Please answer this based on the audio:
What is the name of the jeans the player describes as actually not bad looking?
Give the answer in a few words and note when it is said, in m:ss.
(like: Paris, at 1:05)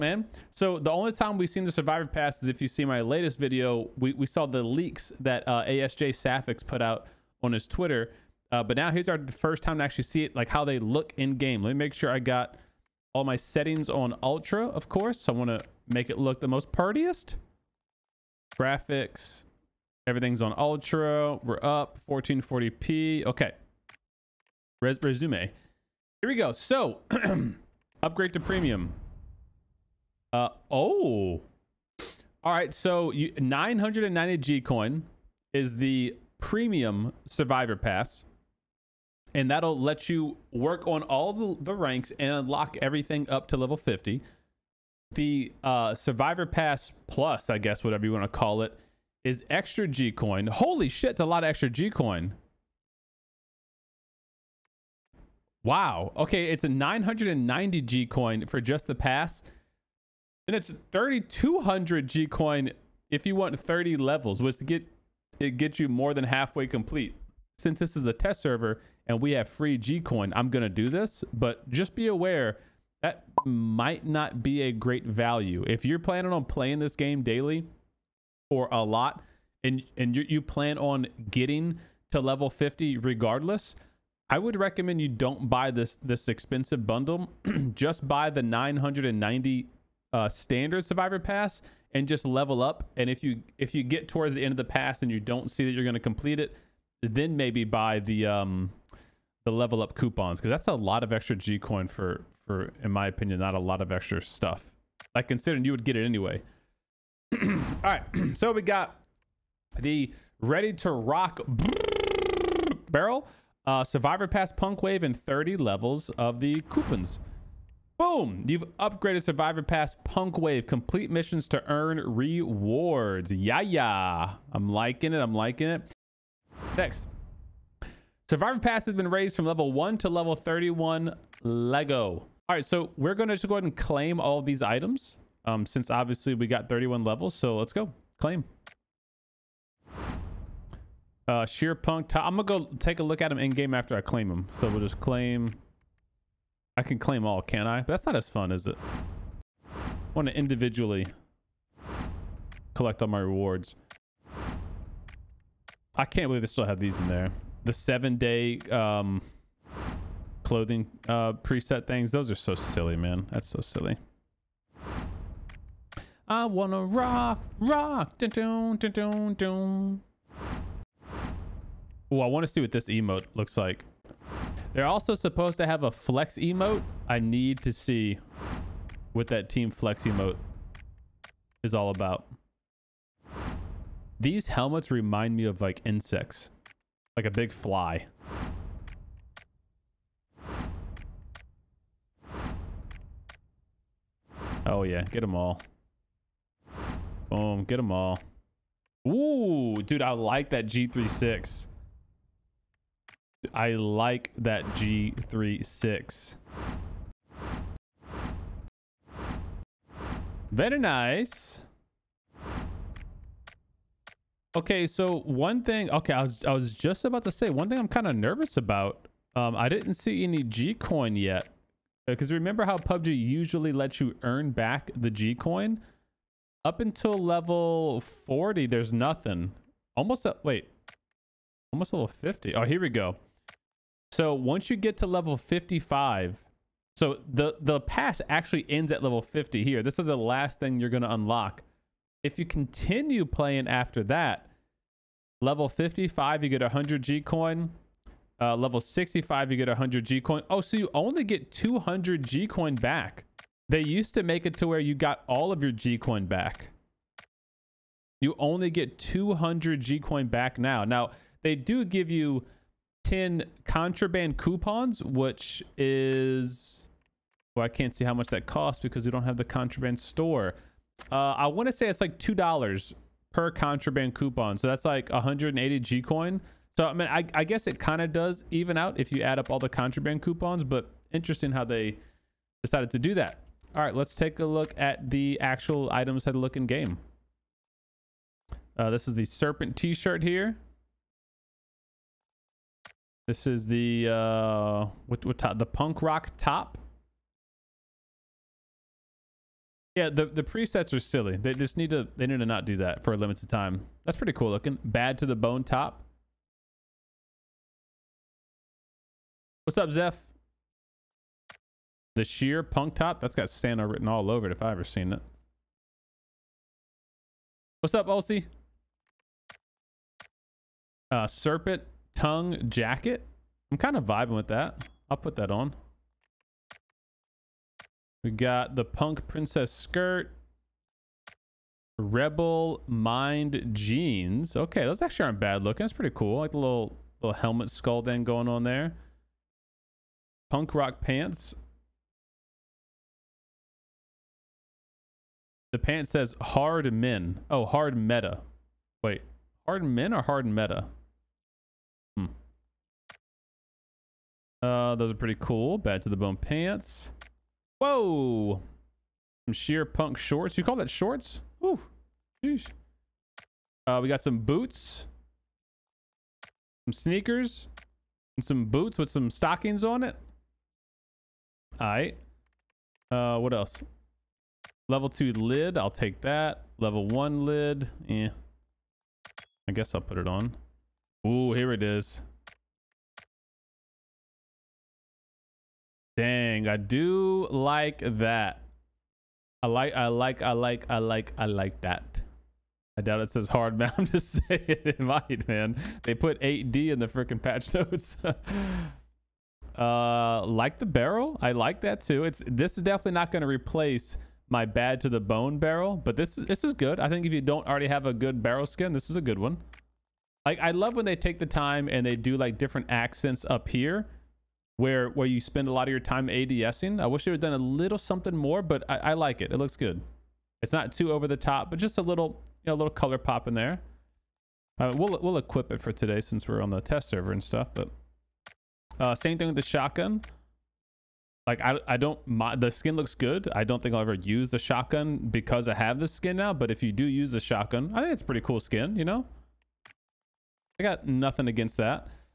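Rebel mind jeans, at 5:31.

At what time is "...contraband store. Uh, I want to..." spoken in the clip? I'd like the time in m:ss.
4:29.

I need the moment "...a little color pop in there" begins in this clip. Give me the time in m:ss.
7:02.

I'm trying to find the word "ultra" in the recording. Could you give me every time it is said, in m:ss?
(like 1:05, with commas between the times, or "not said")
0:14, 0:20.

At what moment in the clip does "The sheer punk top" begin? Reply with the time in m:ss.
5:12.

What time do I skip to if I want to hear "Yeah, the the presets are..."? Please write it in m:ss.
4:59.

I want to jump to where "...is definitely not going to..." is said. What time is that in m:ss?
6:42.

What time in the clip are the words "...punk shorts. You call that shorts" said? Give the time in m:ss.
5:59.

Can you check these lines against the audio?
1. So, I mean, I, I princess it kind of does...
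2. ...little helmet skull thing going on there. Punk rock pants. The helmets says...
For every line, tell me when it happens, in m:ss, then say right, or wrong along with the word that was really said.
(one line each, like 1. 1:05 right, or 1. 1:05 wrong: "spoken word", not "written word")
1. 4:36 wrong: "guess", not "princess"
2. 5:37 wrong: "pants", not "helmets".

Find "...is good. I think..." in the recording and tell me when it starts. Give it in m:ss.
6:46.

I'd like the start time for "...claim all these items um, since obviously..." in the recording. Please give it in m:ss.
2:13.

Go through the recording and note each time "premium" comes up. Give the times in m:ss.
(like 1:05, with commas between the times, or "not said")
0:28, 0:36.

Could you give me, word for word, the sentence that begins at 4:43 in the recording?
All right, let's take a look at the actual items that look in game.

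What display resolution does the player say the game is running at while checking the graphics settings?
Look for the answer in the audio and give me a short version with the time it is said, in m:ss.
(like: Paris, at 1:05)
1440p, at 0:22.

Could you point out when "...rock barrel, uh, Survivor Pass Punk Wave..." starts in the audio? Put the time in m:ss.
1:50.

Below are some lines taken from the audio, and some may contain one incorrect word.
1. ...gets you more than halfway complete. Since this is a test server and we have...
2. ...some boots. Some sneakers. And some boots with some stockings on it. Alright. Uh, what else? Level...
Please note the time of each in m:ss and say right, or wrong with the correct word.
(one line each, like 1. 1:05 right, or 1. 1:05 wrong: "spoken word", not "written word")
1. 1:05 right
2. 6:04 right.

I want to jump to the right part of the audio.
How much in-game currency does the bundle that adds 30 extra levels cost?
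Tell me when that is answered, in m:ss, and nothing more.
1:00.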